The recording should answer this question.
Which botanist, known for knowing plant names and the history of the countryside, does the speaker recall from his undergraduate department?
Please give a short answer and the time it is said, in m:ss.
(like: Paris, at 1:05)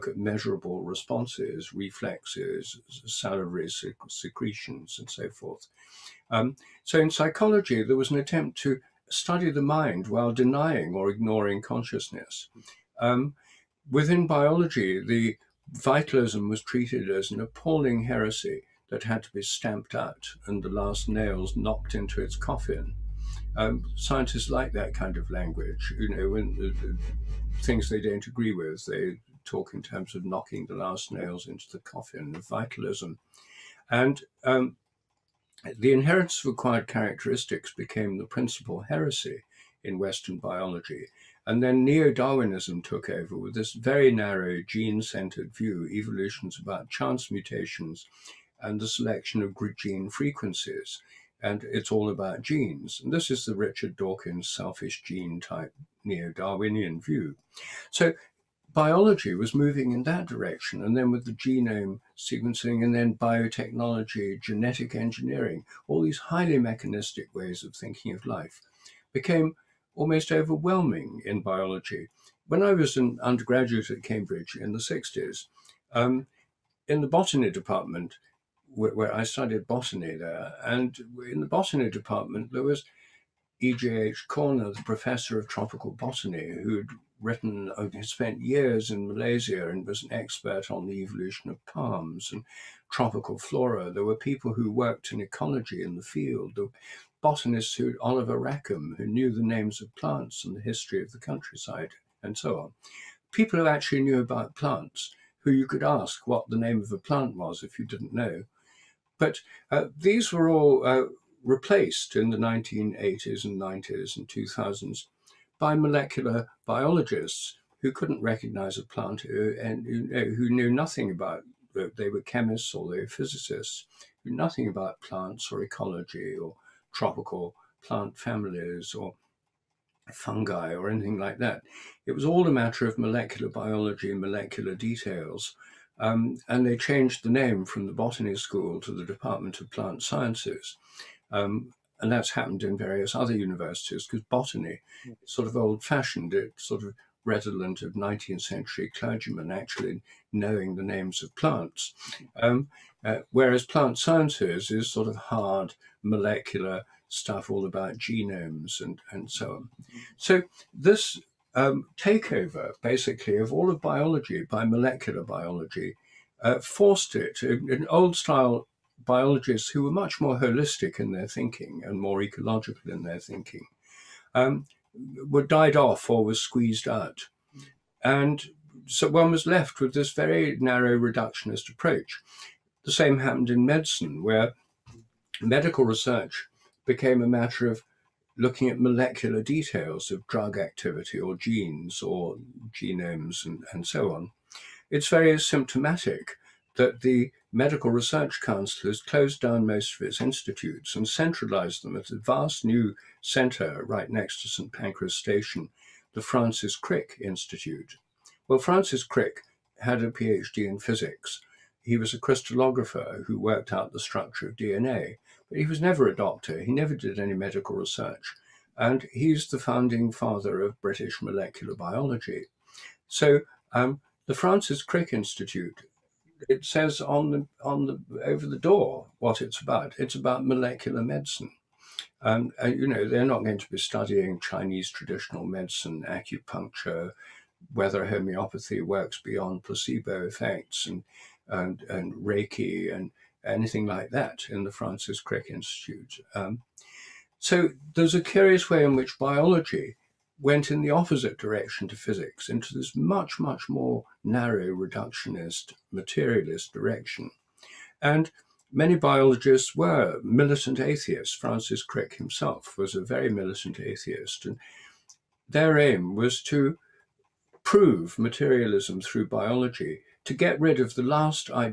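Oliver Rackham, at 1:37.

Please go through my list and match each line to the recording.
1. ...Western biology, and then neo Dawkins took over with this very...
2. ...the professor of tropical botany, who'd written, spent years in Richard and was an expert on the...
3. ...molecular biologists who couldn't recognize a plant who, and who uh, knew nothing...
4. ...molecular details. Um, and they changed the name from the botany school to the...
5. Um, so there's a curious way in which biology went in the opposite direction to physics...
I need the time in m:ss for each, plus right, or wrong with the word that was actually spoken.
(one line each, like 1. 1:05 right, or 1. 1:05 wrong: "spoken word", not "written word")
1. 0:39 wrong: "Darwinism", not "Dawkins"
2. 1:24 wrong: "Malaysia", not "Richard"
3. 1:55 right
4. 2:14 right
5. 4:06 right.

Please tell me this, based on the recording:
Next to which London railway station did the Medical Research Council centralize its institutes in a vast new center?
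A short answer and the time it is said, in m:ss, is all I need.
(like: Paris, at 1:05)
St. Pancras Station, at 3:24.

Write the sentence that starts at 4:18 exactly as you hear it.
And many biologists were militant atheists.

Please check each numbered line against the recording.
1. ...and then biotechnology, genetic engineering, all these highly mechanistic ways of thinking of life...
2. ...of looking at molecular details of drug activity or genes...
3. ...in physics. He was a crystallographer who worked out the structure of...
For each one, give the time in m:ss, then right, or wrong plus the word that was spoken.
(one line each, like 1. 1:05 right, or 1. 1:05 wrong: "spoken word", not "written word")
1. 1:02 right
2. 3:07 right
3. 3:30 right.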